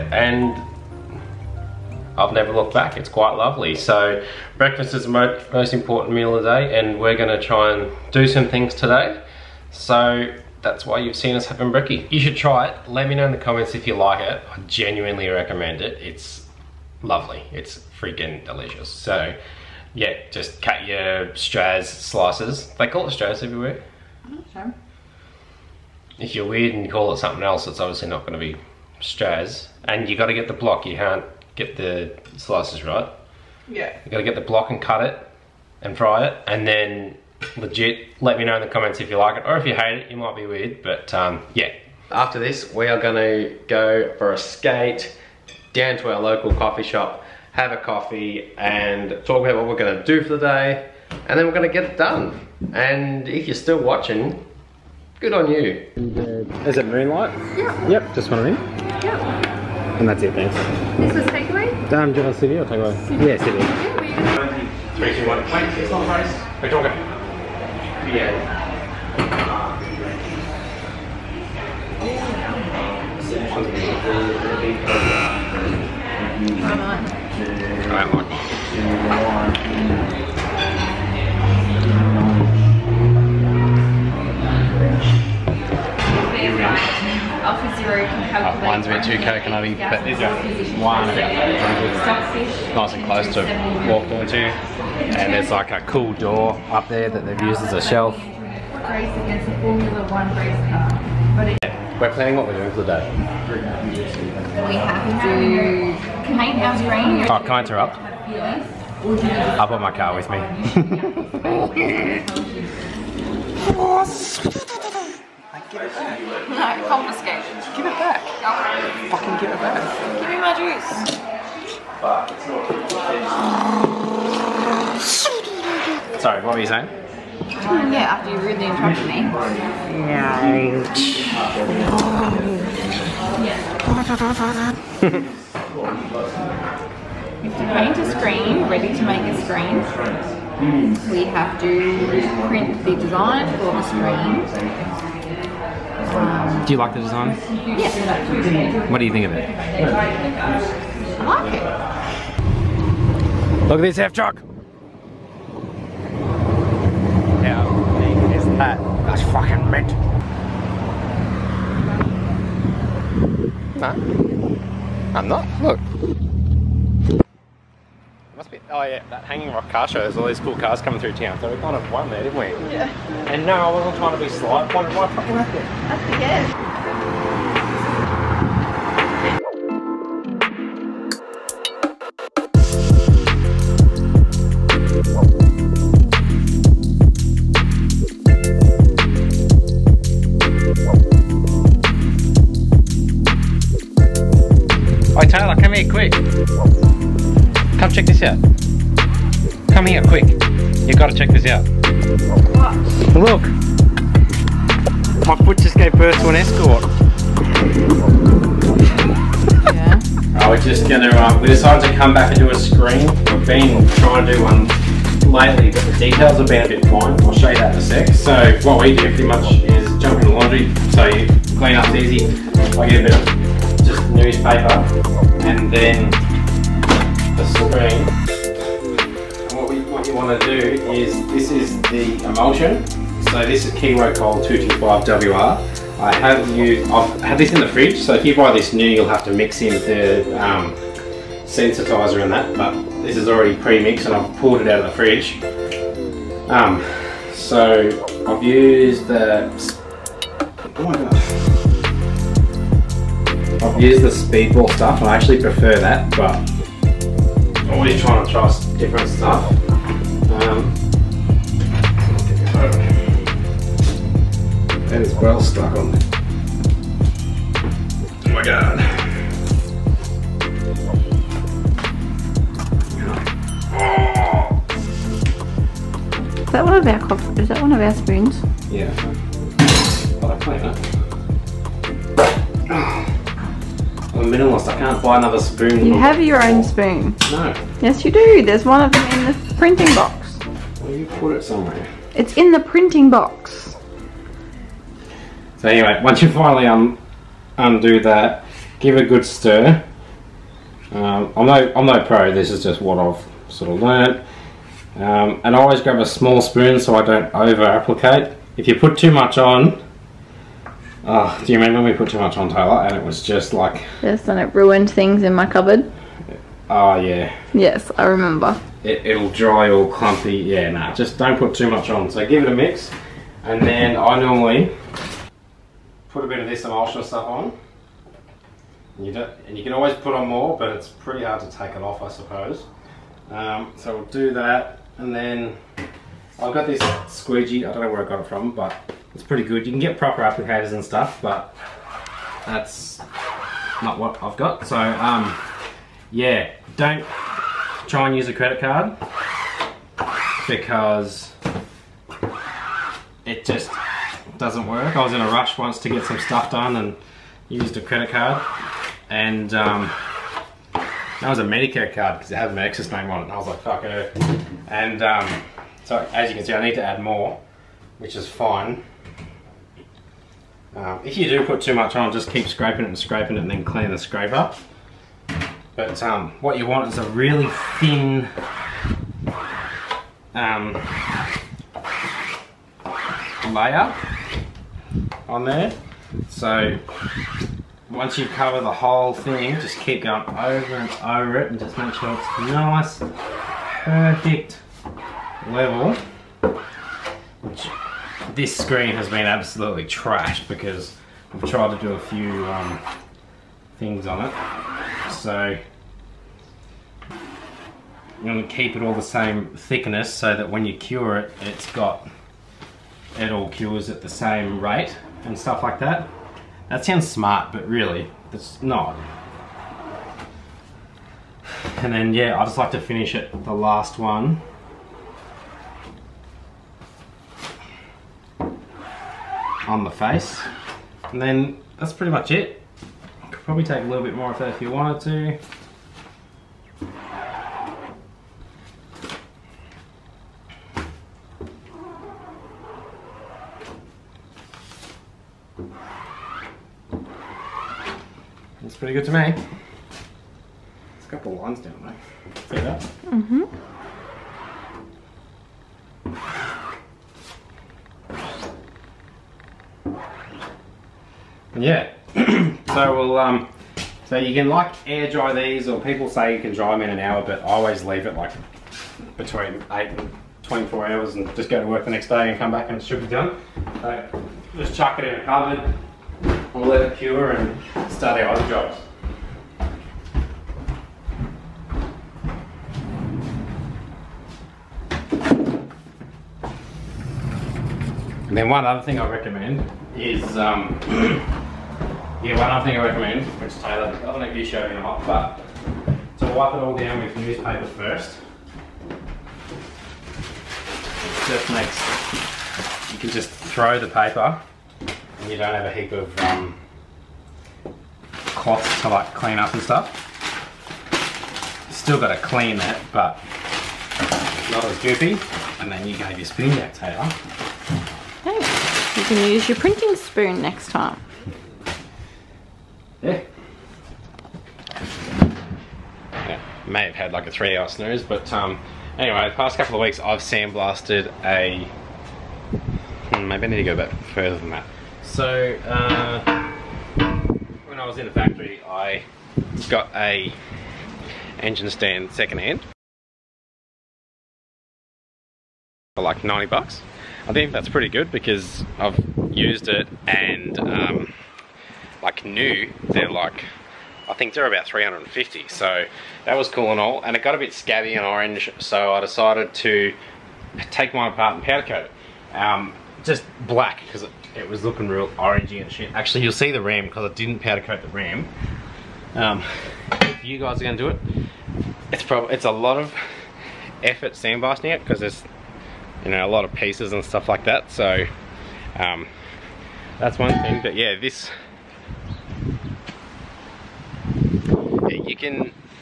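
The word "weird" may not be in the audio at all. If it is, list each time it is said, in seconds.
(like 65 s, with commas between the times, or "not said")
26 s, 40 s.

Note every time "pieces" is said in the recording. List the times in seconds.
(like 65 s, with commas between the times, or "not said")
576 s.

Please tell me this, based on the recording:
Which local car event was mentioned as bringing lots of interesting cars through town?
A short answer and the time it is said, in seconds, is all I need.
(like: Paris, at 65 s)
Hanging Rock car show, at 169 s.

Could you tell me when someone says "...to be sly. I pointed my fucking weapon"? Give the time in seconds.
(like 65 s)
174 s.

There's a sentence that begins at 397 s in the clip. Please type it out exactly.
Which this screen has been absolutely trashed because I've tried to do a few um, things on it.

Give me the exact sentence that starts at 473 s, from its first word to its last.
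So just chuck it in a cupboard, we'll let it cure and start our other jobs.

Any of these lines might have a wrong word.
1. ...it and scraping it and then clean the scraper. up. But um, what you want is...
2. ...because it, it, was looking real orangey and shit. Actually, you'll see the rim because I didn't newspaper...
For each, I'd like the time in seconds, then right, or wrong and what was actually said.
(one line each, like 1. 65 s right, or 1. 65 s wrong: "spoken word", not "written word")
1. 372 s right
2. 563 s wrong: "powder", not "newspaper".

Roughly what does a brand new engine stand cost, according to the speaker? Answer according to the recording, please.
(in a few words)
$350.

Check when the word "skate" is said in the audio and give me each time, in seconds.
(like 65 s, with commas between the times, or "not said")
44 s.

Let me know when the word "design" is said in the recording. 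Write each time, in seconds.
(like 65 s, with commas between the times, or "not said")
142 s, 146 s.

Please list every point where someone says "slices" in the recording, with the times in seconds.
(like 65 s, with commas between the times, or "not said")
21 s, 32 s.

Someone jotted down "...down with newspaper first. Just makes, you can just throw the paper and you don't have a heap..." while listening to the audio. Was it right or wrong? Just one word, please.
right.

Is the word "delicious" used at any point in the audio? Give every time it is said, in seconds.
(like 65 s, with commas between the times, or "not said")
18 s.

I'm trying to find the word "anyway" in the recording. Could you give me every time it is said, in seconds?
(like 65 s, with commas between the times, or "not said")
295 s, 528 s.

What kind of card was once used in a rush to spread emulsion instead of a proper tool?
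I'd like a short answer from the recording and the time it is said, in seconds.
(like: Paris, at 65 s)
Medicare card, at 361 s.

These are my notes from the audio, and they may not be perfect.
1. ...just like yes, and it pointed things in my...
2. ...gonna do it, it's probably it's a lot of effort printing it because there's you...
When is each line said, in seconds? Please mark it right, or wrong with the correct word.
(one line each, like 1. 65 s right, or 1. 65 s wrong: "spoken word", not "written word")
1. 313 s wrong: "ruined", not "pointed"
2. 570 s wrong: "sandblasting", not "printing".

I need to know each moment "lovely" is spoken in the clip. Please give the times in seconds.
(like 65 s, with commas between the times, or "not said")
3 s, 17 s.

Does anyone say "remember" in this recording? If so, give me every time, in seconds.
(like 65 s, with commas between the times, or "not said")
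311 s, 318 s.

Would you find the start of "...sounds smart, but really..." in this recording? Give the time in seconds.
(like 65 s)
416 s.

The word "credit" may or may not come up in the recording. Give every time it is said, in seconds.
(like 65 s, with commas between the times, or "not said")
348 s, 357 s.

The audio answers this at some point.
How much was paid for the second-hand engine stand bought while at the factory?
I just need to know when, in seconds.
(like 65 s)
546 s.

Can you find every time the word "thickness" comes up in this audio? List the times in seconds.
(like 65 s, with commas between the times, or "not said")
409 s.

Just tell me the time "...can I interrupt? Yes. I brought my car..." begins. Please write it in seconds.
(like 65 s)
107 s.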